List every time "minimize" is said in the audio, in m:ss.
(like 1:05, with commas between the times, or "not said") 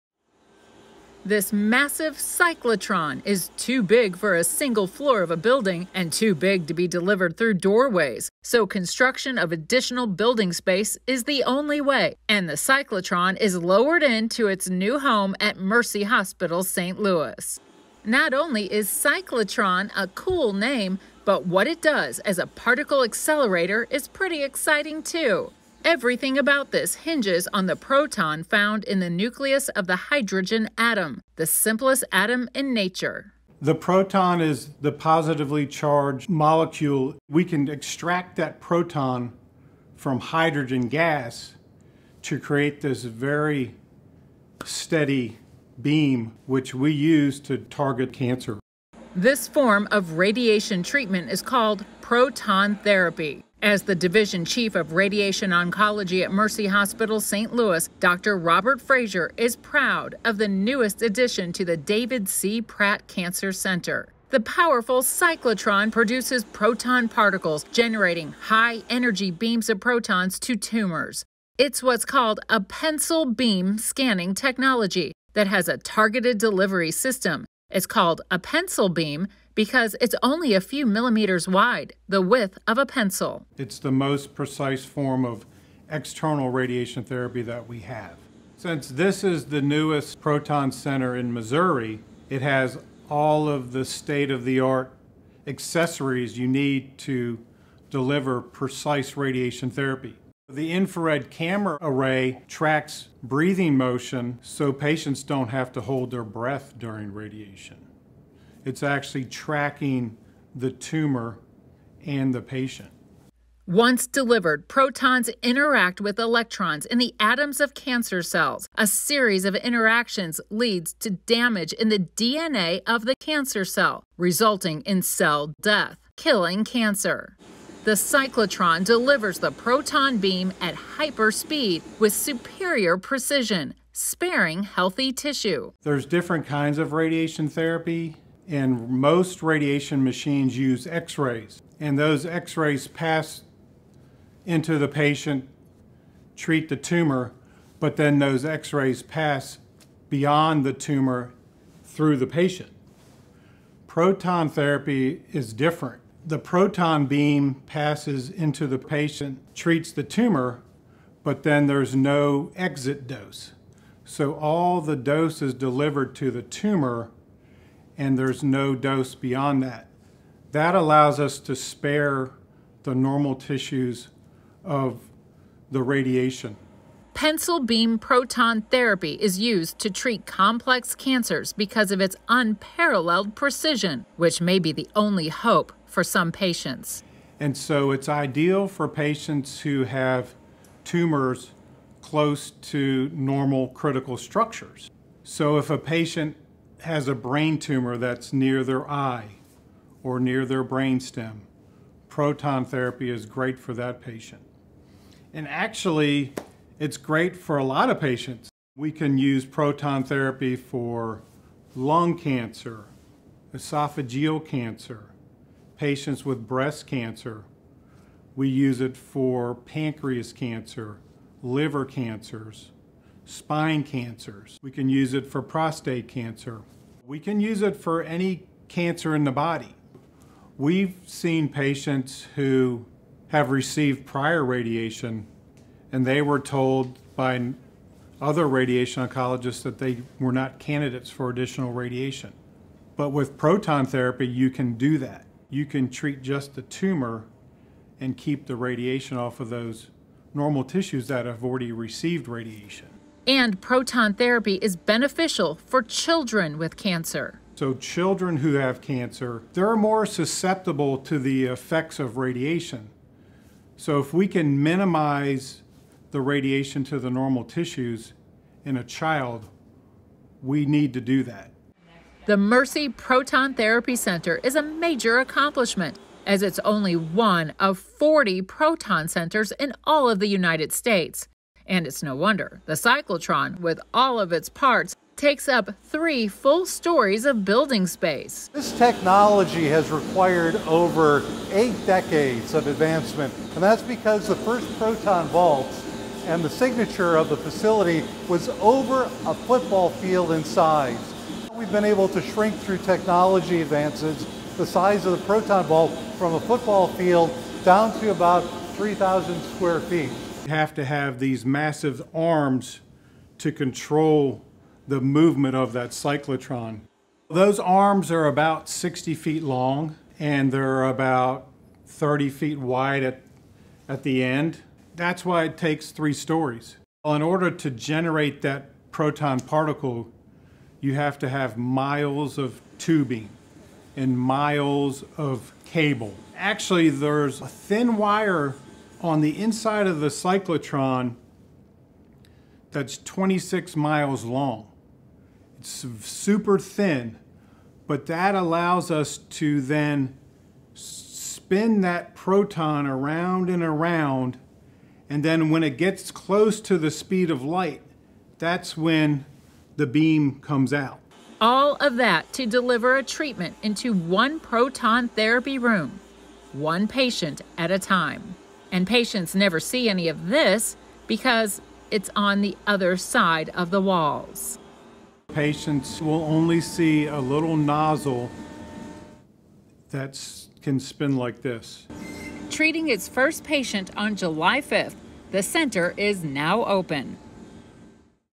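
4:24.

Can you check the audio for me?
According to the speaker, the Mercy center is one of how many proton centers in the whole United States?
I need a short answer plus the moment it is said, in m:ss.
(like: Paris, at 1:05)
40, at 4:37.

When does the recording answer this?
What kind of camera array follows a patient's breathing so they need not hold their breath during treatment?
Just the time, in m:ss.
1:40.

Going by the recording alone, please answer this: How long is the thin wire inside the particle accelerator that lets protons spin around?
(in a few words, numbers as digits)
26 miles.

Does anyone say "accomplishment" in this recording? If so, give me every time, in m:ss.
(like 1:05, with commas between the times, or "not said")
4:35.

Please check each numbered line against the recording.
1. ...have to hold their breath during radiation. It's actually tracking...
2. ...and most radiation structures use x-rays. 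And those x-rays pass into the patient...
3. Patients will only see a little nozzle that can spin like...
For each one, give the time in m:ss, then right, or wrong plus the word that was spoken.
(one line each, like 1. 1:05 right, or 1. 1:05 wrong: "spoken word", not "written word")
1. 1:45 right
2. 2:18 wrong: "machines", not "structures"
3. 6:15 right.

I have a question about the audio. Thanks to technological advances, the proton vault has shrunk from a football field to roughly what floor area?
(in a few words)
3,000 square feet.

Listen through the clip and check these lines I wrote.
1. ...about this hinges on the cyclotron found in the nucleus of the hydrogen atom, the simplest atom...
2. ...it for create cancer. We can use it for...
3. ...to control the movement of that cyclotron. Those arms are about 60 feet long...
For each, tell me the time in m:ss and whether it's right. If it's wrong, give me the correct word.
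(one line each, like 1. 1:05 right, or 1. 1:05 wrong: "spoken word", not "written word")
1. 0:26 wrong: "proton", not "cyclotron"
2. 3:45 wrong: "prostate", not "create"
3. 5:13 right.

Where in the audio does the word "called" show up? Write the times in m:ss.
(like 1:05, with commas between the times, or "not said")
0:51, 1:12, 1:17.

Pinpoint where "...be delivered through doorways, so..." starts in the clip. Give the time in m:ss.
0:06.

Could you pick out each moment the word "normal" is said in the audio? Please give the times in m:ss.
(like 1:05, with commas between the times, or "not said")
2:52, 3:13, 4:10, 4:27.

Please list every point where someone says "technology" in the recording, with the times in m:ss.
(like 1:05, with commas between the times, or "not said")
1:14, 4:48, 5:02.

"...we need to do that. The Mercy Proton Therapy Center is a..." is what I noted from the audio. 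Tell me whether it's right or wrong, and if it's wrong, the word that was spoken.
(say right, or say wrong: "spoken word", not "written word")
right.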